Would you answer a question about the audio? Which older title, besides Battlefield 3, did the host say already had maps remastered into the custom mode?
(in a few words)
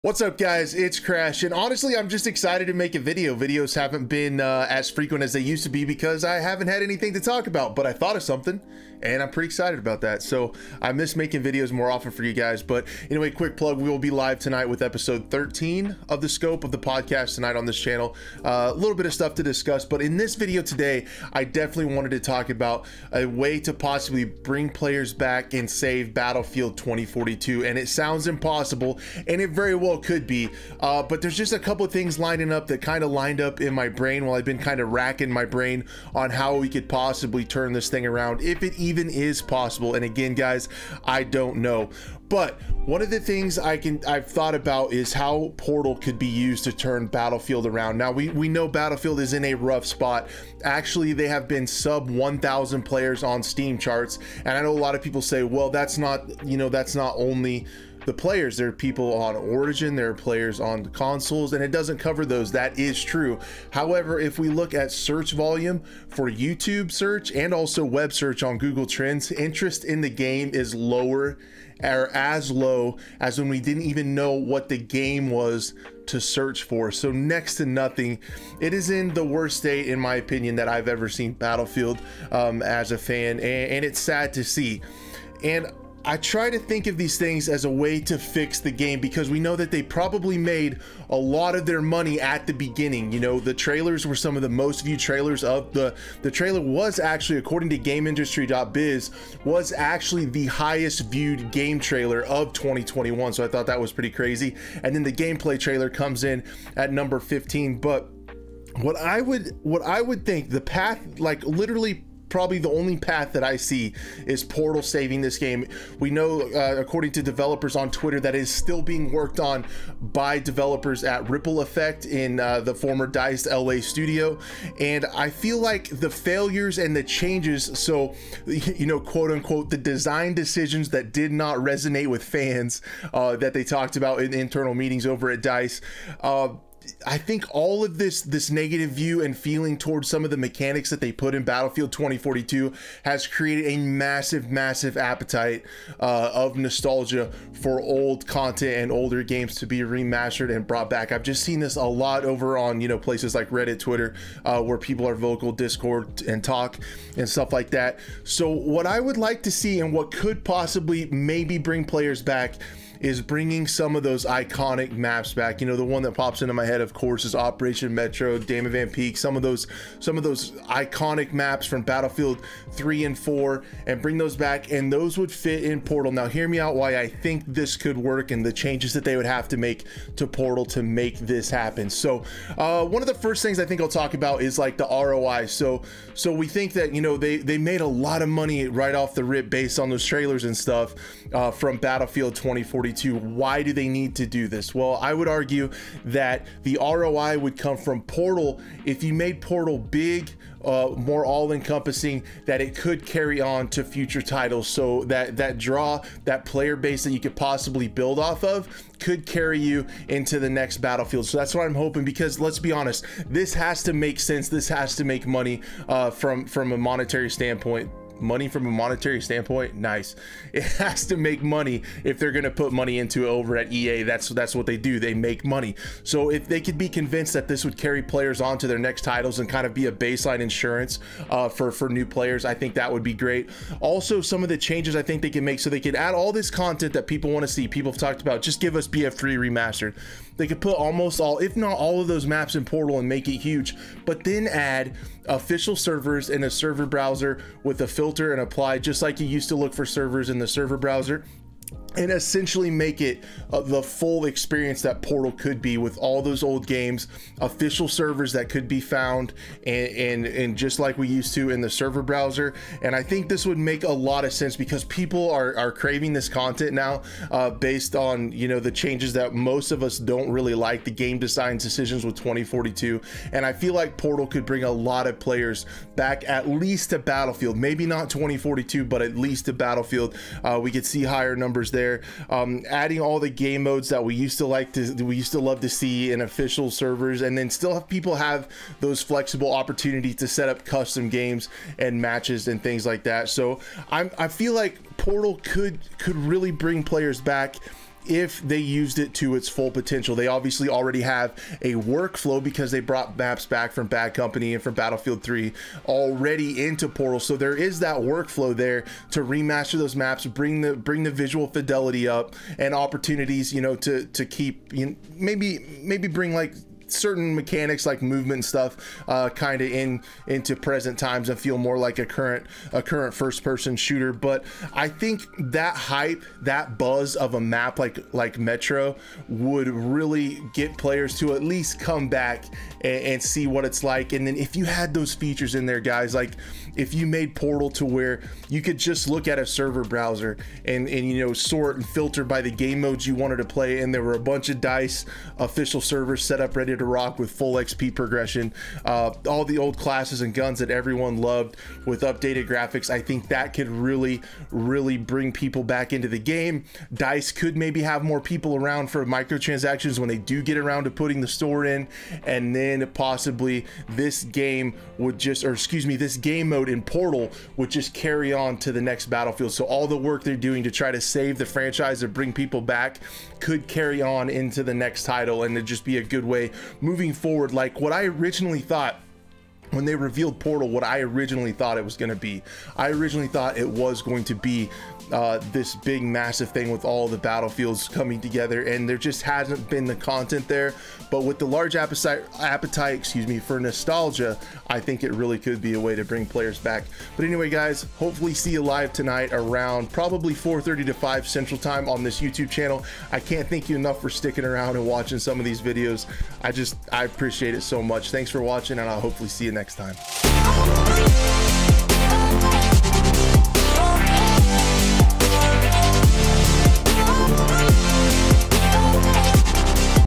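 Bad Company.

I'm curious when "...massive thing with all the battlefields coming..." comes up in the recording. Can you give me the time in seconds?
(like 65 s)
386 s.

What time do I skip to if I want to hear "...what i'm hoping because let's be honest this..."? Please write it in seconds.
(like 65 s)
211 s.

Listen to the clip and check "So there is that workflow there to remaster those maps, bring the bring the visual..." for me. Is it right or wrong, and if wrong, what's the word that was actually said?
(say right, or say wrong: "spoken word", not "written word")
right.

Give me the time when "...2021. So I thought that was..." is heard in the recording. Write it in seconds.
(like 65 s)
102 s.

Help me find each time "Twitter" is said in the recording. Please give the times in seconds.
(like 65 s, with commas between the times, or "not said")
117 s, 153 s.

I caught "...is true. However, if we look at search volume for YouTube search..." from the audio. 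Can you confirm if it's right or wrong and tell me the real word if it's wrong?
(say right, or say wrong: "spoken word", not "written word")
right.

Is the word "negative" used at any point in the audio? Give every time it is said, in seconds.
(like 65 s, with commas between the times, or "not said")
138 s.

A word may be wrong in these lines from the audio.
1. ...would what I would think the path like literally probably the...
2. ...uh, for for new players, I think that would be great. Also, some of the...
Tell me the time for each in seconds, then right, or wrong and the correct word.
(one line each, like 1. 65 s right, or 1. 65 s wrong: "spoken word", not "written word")
1. 109 s right
2. 231 s right.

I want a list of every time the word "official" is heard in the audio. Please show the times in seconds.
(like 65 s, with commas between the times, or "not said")
245 s, 257 s, 286 s, 345 s.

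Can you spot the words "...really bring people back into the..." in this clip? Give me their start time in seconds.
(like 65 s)
354 s.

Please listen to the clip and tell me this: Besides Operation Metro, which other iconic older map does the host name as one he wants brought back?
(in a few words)
Damavand Peak.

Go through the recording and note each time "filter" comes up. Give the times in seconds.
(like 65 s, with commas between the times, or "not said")
247 s, 341 s.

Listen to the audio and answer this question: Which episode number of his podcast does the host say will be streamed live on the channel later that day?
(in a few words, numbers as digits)
13.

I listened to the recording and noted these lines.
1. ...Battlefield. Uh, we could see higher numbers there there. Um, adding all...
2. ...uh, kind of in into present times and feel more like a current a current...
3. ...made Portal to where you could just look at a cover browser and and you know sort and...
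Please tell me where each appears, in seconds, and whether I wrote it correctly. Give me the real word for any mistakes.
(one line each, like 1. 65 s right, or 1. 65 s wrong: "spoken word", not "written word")
1. 279 s right
2. 319 s right
3. 337 s wrong: "server", not "cover".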